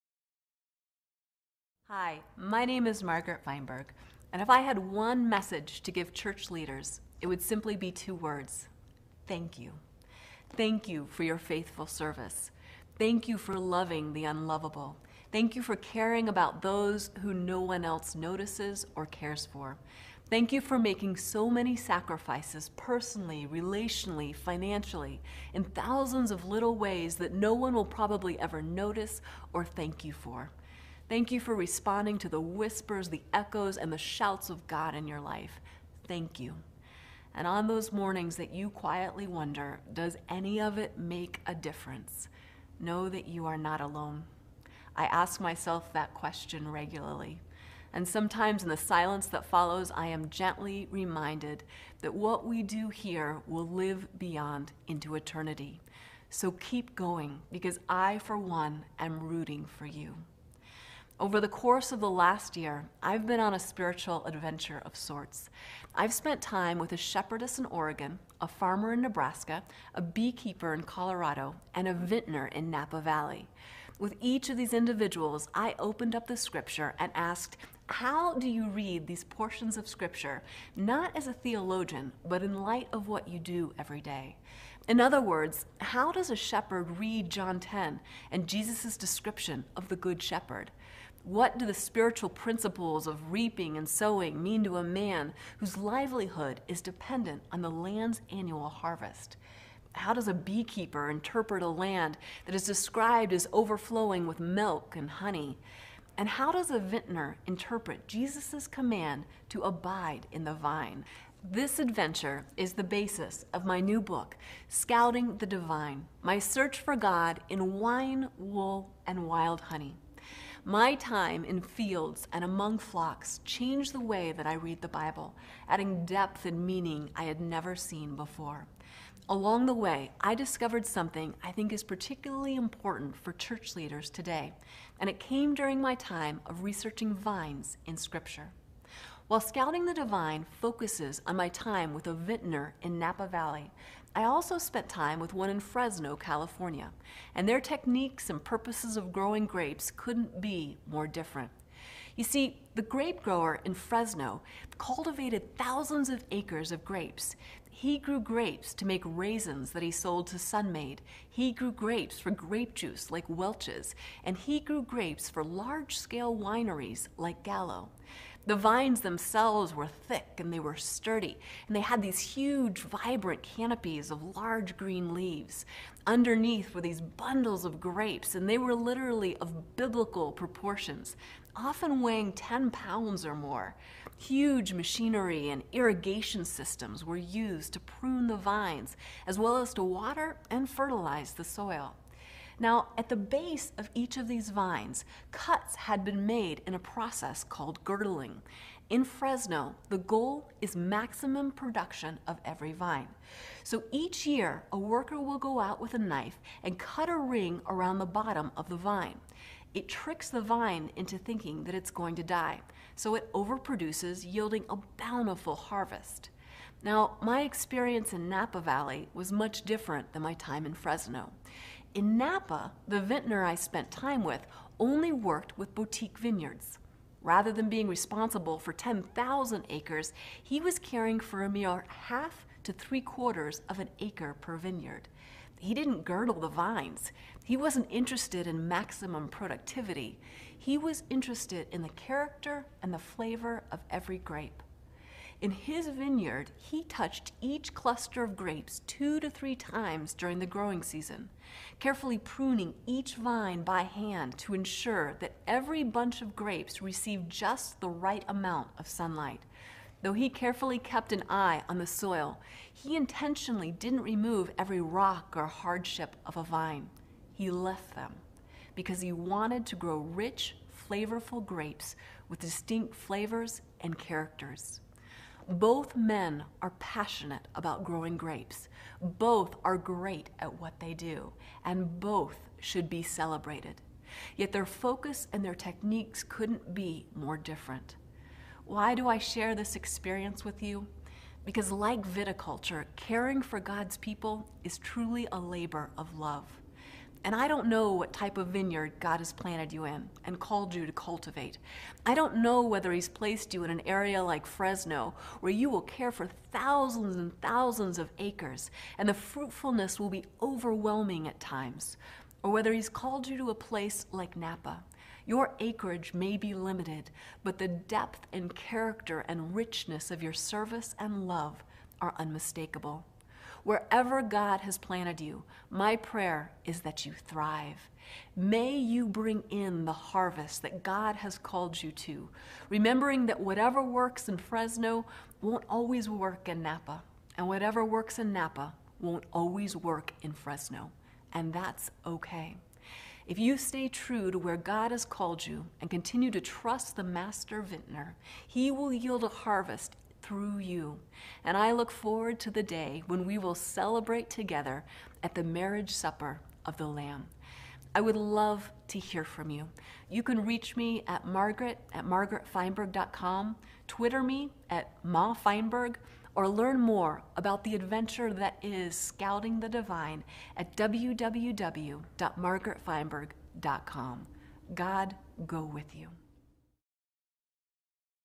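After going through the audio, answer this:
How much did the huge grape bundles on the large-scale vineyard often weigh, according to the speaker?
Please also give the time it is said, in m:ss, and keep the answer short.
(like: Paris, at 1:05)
10 pounds or more, at 3:02.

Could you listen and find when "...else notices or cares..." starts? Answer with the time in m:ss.
0:17.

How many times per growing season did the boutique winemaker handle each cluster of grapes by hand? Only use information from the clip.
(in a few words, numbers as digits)
2 to 3 times.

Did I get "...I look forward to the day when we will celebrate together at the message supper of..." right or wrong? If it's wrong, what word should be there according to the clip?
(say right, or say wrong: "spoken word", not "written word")
wrong: "marriage", not "message".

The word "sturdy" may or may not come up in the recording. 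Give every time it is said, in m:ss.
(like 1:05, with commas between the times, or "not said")
2:50.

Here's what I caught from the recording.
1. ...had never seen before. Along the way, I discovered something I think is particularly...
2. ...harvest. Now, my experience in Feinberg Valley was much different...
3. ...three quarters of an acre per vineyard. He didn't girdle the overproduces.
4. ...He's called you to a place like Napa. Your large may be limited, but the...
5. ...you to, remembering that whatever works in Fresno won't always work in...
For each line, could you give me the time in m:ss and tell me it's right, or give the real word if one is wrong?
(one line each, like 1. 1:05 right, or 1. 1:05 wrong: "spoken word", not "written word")
1. 2:07 right
2. 3:35 wrong: "Napa", not "Feinberg"
3. 3:52 wrong: "vines", not "overproduces"
4. 5:12 wrong: "acreage", not "large"
5. 5:31 right.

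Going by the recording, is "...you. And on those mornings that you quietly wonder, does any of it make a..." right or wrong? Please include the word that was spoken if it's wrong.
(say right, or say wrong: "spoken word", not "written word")
right.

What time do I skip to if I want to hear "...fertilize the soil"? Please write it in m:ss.
3:10.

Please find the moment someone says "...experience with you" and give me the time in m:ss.
4:49.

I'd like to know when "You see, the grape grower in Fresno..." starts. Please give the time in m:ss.
2:32.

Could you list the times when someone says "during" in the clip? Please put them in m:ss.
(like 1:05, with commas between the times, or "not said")
2:15, 4:10.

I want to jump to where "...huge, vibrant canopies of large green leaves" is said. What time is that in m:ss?
2:52.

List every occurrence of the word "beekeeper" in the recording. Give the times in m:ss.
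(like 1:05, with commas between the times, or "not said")
1:10, 1:40.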